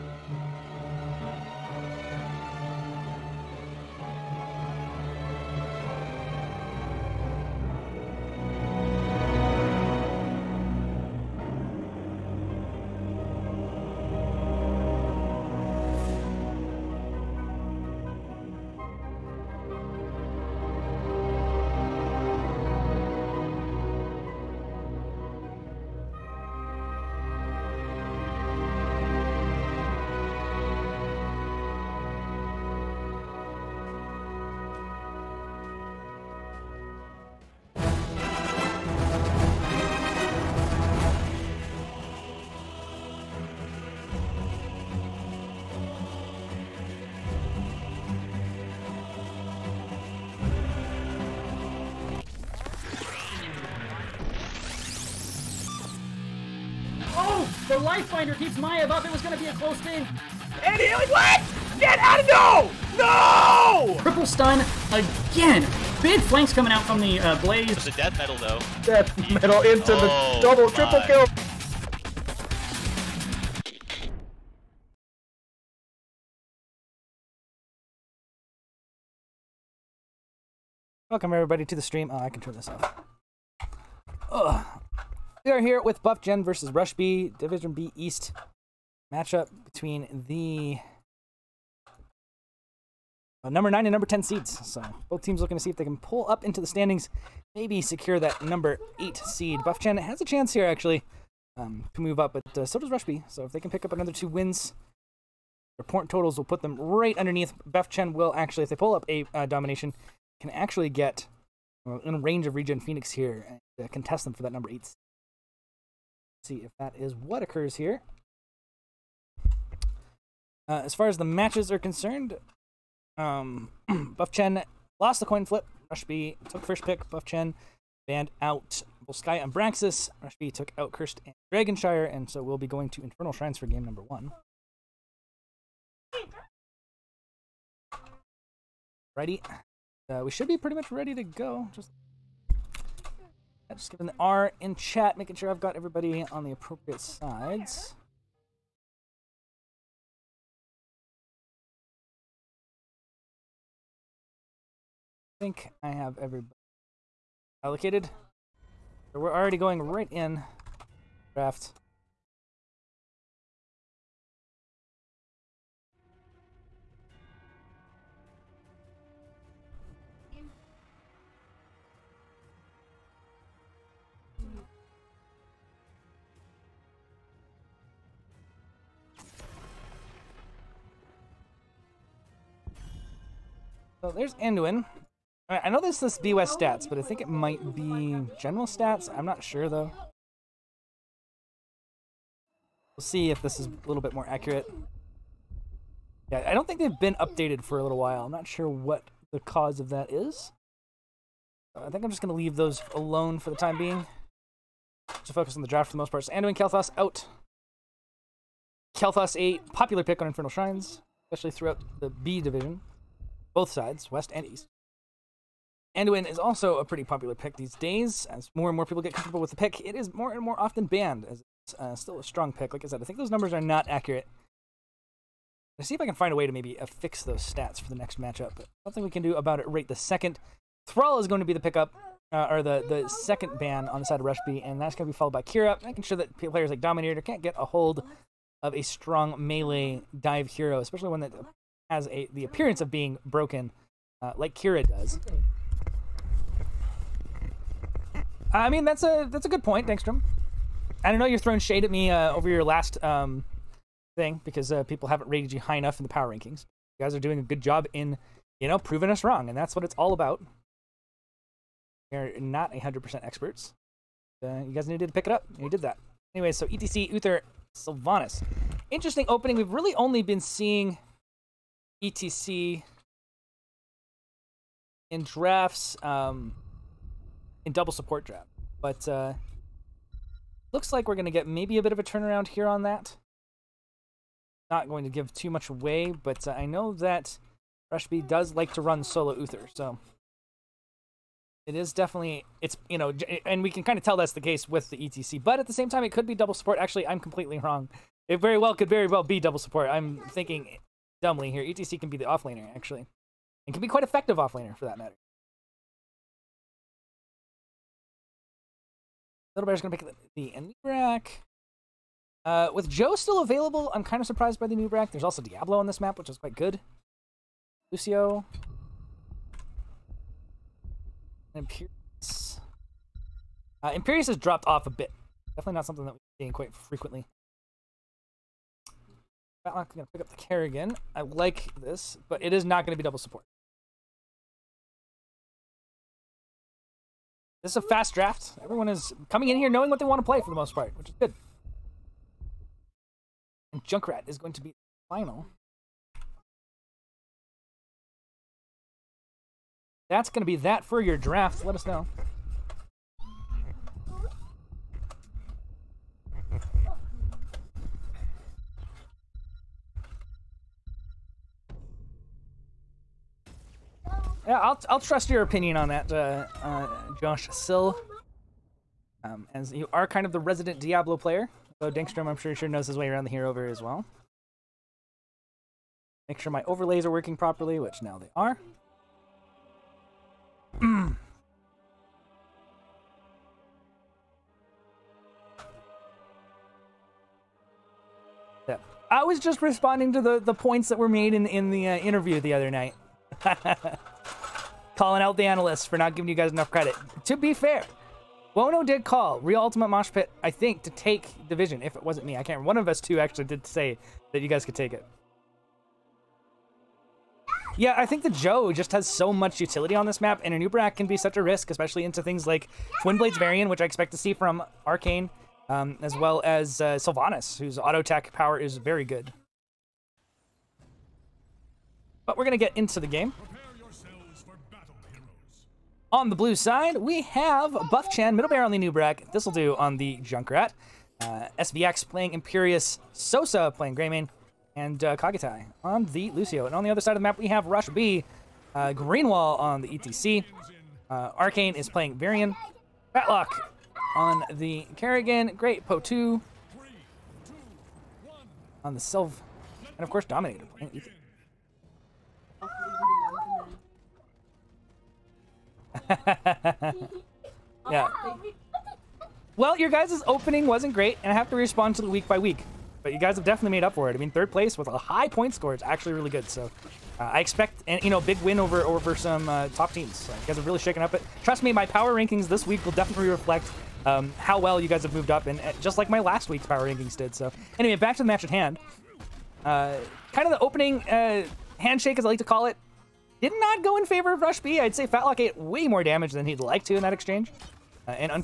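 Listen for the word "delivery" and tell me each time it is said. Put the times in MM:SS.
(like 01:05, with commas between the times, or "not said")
not said.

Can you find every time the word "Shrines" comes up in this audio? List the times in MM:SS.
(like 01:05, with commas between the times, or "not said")
02:13, 03:30.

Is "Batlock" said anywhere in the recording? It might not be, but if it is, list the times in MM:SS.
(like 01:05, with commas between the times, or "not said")
05:29, 07:23, 08:05.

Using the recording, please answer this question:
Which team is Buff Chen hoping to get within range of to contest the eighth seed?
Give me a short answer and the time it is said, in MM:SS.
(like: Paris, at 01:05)
Regen Phoenix, at 01:52.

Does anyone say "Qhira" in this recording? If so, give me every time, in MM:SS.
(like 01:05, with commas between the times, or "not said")
03:55, 04:04.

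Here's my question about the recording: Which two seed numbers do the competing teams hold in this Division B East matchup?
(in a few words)
9 and 10.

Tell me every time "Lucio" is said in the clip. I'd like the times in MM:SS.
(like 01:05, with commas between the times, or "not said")
05:17, 07:16.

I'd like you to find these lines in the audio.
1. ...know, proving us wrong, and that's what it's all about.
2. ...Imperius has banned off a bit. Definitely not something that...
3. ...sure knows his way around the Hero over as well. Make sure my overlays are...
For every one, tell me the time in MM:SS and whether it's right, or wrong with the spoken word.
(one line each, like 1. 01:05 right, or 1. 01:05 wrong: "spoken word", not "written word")
1. 04:18 right
2. 05:23 wrong: "dropped", not "banned"
3. 06:12 right.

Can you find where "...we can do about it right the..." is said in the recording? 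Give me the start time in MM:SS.
03:49.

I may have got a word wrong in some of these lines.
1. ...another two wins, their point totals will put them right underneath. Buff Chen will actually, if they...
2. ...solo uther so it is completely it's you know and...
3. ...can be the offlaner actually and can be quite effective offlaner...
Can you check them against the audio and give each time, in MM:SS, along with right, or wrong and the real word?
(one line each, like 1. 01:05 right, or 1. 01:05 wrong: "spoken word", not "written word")
1. 01:43 right
2. 04:49 wrong: "definitely", not "completely"
3. 05:01 right.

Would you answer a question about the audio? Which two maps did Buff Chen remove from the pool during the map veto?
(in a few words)
Volsky and Braxis.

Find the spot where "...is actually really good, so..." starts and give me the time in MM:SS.
07:45.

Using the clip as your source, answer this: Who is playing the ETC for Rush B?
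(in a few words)
Greenwall.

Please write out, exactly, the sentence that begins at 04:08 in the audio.
I mean, that's a that's a good point, Dankstrom.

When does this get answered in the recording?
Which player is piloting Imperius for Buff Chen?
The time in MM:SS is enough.
07:11.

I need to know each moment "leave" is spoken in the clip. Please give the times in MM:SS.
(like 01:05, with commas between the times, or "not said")
03:22.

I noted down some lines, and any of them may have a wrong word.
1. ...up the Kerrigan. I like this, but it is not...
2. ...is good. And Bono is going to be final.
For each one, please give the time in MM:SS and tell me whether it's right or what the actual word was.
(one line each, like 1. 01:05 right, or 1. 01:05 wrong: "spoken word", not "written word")
1. 05:30 right
2. 05:41 wrong: "Junkrat", not "Bono".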